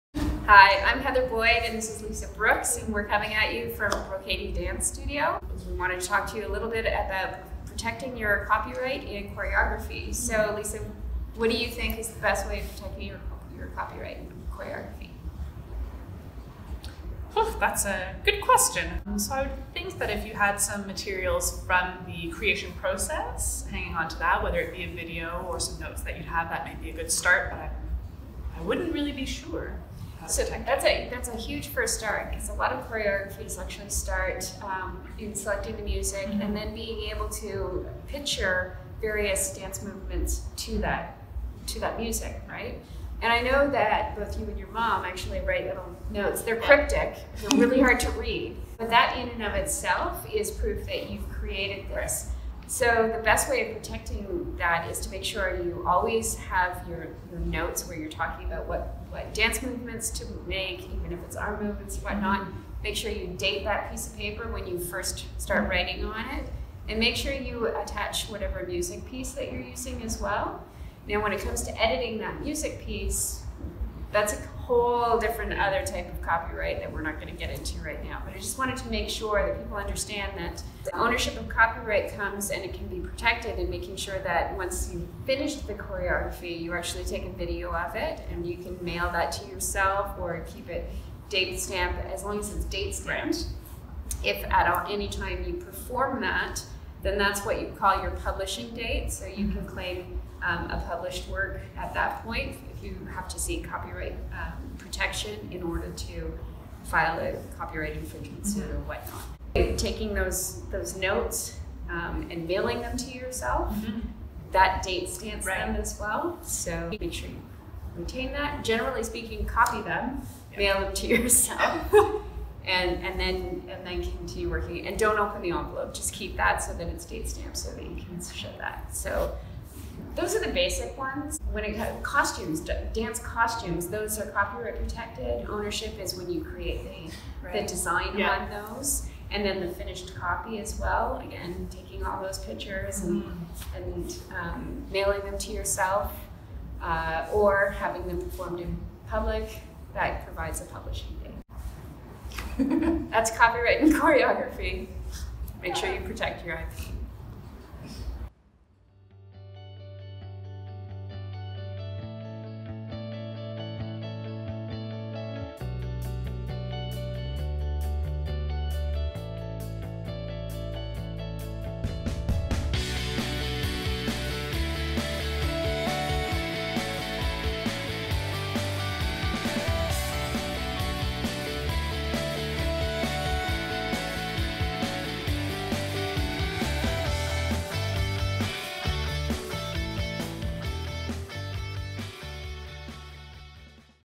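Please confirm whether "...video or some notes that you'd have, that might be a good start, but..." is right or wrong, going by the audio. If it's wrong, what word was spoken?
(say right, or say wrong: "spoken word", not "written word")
right.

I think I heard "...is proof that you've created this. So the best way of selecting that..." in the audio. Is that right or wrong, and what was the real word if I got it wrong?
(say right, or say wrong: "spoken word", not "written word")
wrong: "protecting", not "selecting".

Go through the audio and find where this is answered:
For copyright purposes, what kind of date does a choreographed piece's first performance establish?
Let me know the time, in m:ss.
1:38.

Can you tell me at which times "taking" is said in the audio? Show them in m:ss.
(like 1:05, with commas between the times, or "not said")
1:49, 2:21.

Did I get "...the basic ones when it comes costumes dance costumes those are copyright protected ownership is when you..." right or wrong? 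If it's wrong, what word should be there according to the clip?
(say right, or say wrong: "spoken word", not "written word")
right.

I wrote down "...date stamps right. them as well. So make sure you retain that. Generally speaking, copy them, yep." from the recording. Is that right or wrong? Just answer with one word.
right.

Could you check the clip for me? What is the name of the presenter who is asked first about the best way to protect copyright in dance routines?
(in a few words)
Lisa Brooks.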